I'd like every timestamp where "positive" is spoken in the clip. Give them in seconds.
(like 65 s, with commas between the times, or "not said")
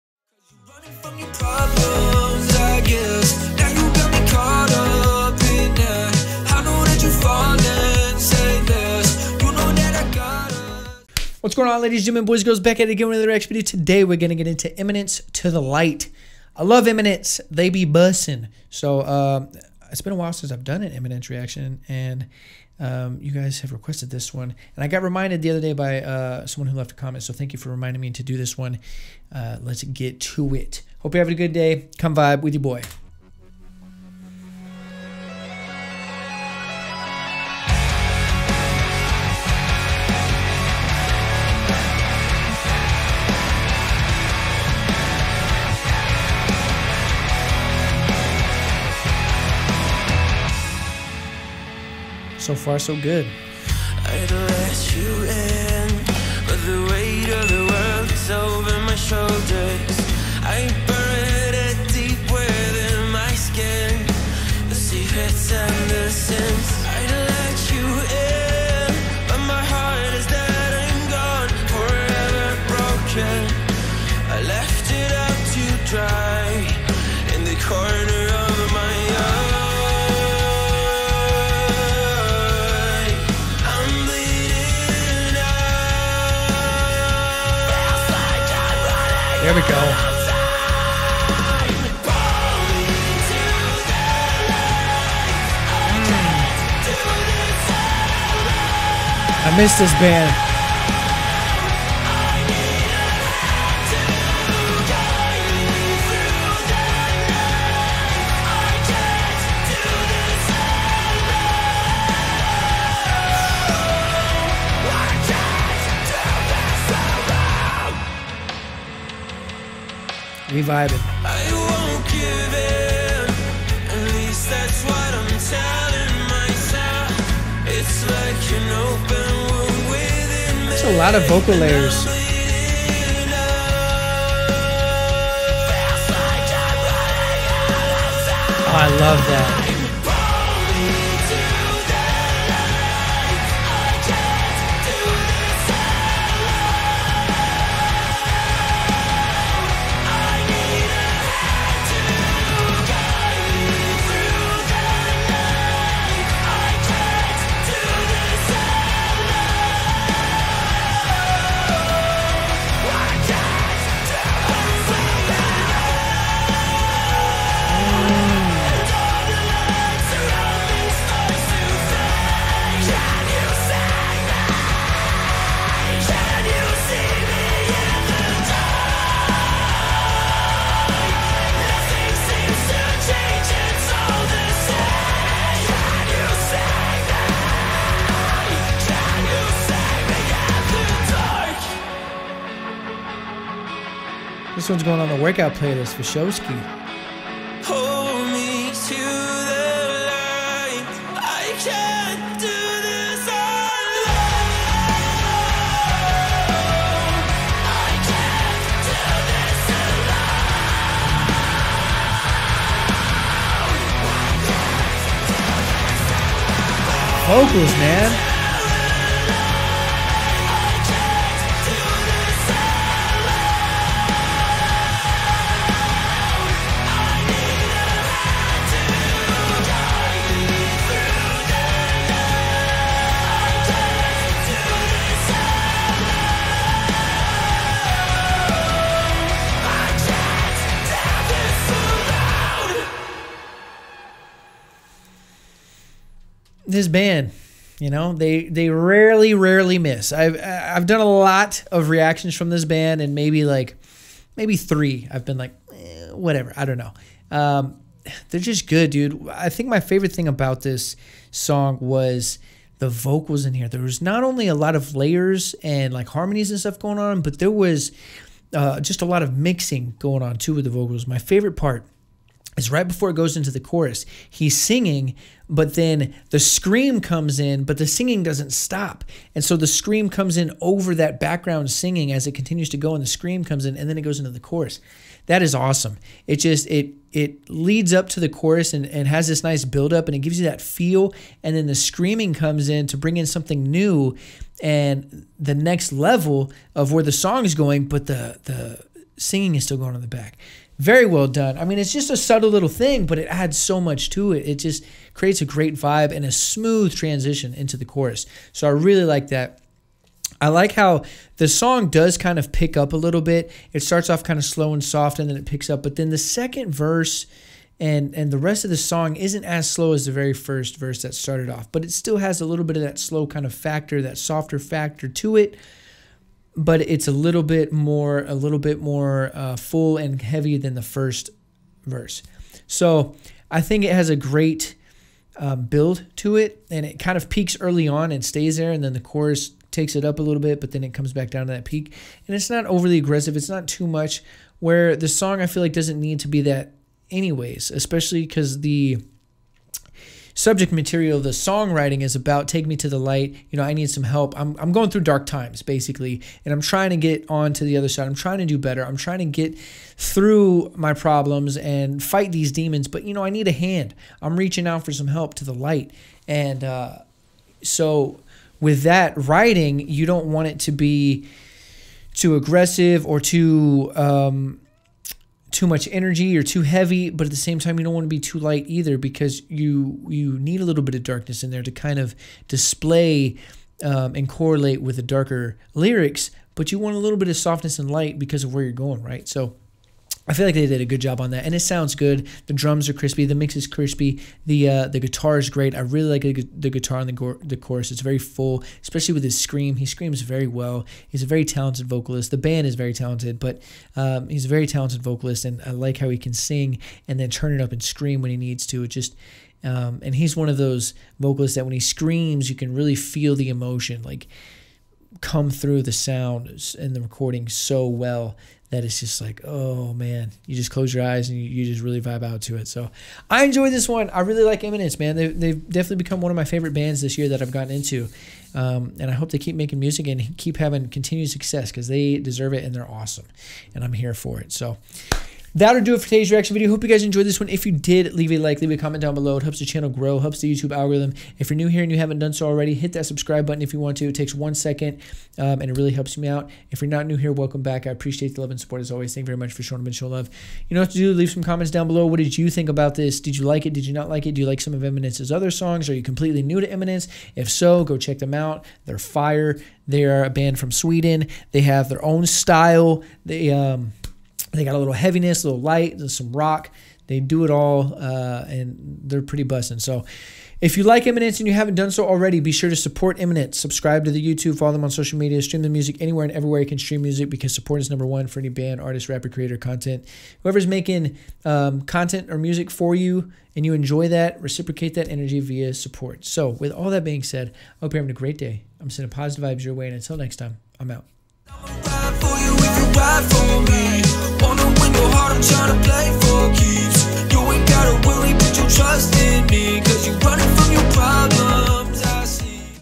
489 s.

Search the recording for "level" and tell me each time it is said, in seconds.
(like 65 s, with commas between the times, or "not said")
295 s.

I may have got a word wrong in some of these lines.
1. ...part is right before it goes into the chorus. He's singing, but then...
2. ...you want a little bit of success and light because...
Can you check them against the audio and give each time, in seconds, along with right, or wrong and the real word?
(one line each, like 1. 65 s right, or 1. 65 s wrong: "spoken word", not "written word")
1. 271 s right
2. 386 s wrong: "softness", not "success".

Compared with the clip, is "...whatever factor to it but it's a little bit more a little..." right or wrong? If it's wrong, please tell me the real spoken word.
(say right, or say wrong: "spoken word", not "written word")
wrong: "softer", not "whatever".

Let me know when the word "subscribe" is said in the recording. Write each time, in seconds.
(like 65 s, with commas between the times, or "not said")
443 s, 473 s.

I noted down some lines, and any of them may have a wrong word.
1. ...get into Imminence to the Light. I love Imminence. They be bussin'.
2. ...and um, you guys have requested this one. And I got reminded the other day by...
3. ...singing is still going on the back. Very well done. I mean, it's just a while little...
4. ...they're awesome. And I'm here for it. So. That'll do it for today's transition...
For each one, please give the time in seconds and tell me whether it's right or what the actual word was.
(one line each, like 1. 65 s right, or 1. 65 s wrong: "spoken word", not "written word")
1. 14 s right
2. 21 s right
3. 299 s wrong: "subtle", not "while"
4. 432 s wrong: "reaction", not "transition".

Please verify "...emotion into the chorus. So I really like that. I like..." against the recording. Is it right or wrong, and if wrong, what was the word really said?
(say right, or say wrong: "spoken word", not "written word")
wrong: "transition", not "emotion".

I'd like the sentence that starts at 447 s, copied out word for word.
I appreciate the love and support as always.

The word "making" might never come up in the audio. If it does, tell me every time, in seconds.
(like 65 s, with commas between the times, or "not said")
429 s, 480 s.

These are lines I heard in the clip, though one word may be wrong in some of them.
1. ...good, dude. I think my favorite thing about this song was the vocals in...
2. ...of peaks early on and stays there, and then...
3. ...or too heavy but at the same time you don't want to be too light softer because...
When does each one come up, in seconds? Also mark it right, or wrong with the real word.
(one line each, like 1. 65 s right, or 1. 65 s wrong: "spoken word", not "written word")
1. 258 s right
2. 337 s right
3. 376 s wrong: "either", not "softer".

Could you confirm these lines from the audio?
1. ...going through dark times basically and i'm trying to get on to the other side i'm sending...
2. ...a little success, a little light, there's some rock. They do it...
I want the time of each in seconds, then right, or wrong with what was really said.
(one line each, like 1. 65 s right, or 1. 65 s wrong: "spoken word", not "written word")
1. 354 s wrong: "trying", not "sending"
2. 464 s wrong: "heaviness", not "success".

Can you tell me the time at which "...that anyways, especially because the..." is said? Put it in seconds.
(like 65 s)
346 s.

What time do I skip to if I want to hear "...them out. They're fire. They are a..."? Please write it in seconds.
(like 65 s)
458 s.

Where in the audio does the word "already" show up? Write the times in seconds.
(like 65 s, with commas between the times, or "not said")
442 s, 472 s.